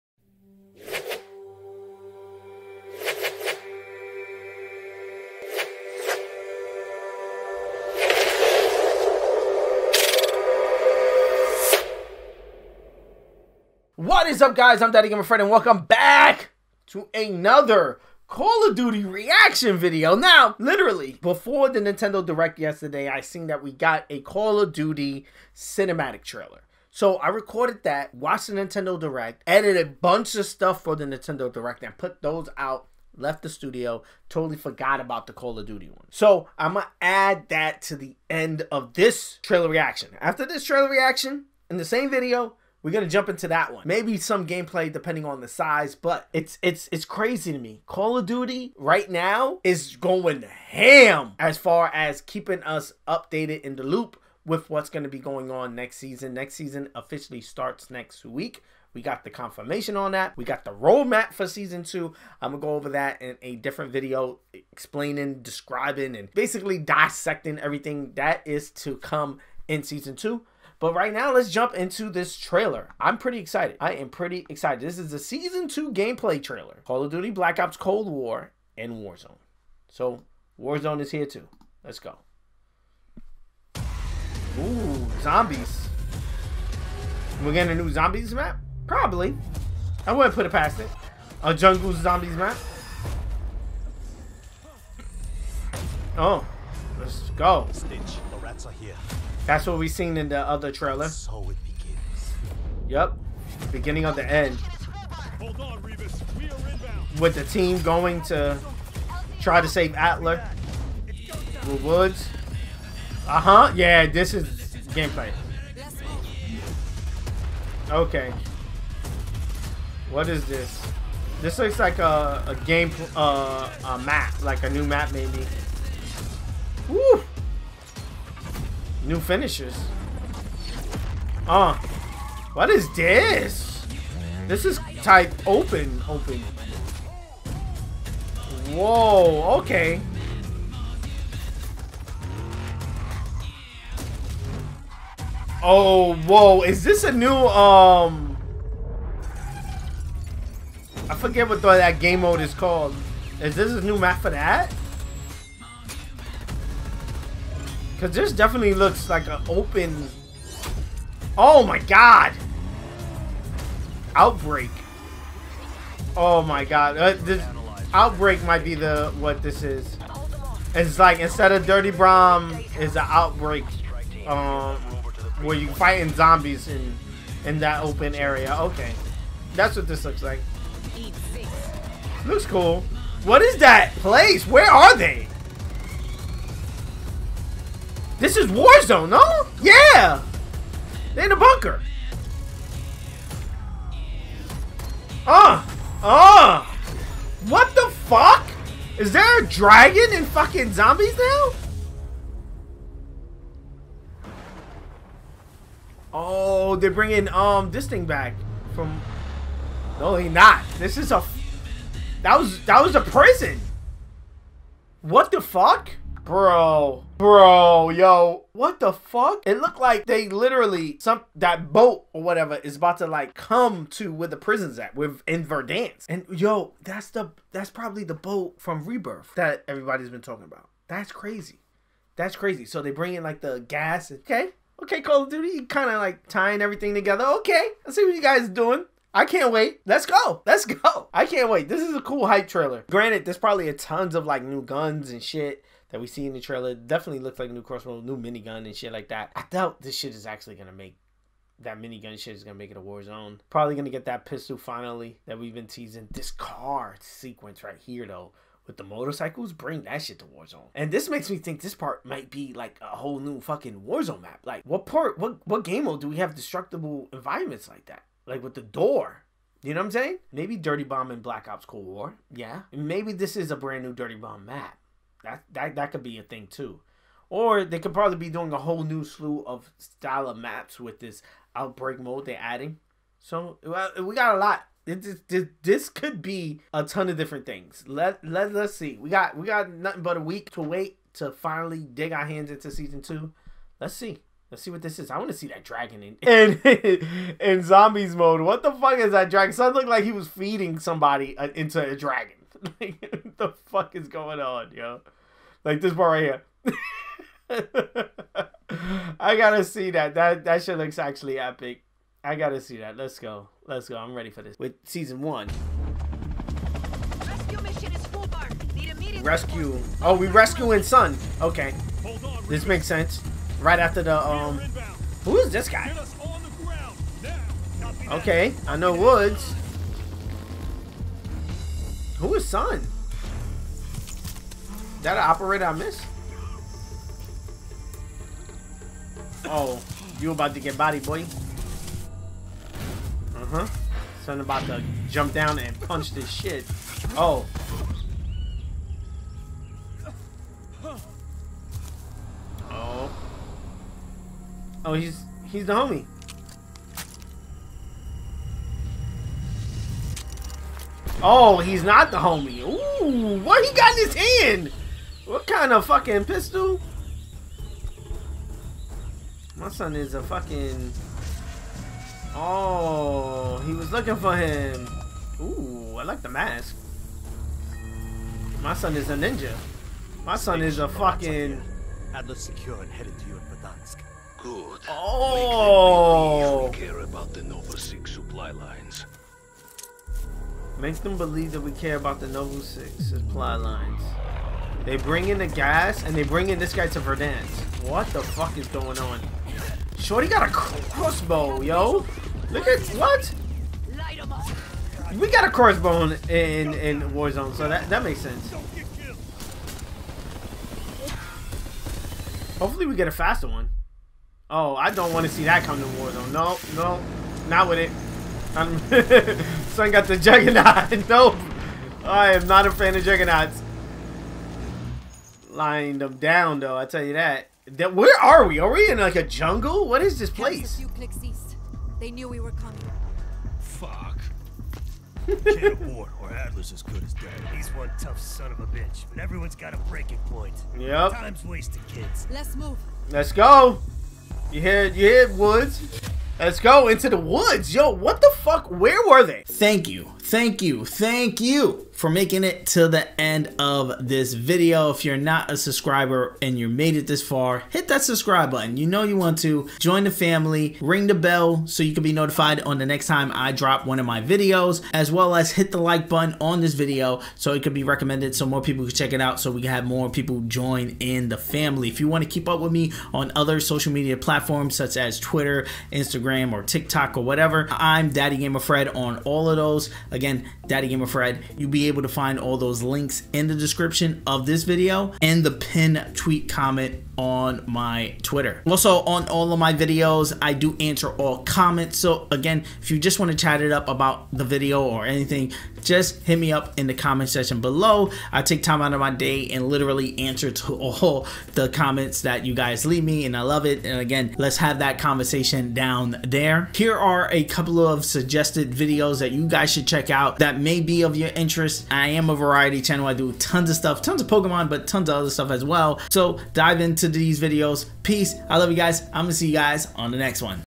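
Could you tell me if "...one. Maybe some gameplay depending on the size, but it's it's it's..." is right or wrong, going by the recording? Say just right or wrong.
right.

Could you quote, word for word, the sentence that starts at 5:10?
That that shit looks actually epic.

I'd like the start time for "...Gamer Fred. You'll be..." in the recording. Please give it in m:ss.
8:00.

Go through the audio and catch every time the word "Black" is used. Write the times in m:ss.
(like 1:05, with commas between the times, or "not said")
1:17, 4:31.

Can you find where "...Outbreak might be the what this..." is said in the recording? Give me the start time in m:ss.
2:47.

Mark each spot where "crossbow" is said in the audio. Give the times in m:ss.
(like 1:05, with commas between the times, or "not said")
4:07, 6:40, 6:45.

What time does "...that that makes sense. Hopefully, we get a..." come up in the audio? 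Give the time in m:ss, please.
6:47.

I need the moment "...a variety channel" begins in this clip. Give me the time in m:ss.
8:32.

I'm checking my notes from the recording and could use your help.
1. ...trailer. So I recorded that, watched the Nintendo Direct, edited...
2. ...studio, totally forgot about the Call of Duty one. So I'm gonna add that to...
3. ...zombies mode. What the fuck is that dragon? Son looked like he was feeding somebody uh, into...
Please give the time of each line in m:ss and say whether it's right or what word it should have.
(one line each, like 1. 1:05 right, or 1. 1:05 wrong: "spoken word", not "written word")
1. 0:26 right
2. 0:33 right
3. 4:57 right.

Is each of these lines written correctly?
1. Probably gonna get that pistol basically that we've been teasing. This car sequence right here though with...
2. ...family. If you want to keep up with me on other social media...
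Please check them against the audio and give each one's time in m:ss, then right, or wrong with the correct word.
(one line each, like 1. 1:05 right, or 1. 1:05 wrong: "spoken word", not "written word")
1. 4:13 wrong: "finally", not "basically"
2. 7:51 right.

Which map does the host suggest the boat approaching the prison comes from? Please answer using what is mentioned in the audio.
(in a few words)
Rebirth.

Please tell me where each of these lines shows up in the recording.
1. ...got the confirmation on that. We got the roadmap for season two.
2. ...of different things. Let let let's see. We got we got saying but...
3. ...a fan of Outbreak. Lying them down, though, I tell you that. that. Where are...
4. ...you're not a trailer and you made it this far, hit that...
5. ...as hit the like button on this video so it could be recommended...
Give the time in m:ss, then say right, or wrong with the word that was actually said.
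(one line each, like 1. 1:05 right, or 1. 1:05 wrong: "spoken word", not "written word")
1. 0:59 right
2. 4:47 wrong: "nothing", not "saying"
3. 7:02 wrong: "Juggernauts", not "Outbreak"
4. 7:35 wrong: "subscriber", not "trailer"
5. 7:45 right.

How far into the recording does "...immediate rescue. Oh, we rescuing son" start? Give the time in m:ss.
5:18.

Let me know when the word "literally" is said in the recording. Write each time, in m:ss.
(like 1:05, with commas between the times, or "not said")
0:20, 3:40, 8:19.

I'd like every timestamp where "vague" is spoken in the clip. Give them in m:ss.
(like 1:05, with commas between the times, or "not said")
not said.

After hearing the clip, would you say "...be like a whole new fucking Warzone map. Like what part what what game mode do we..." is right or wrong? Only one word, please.
right.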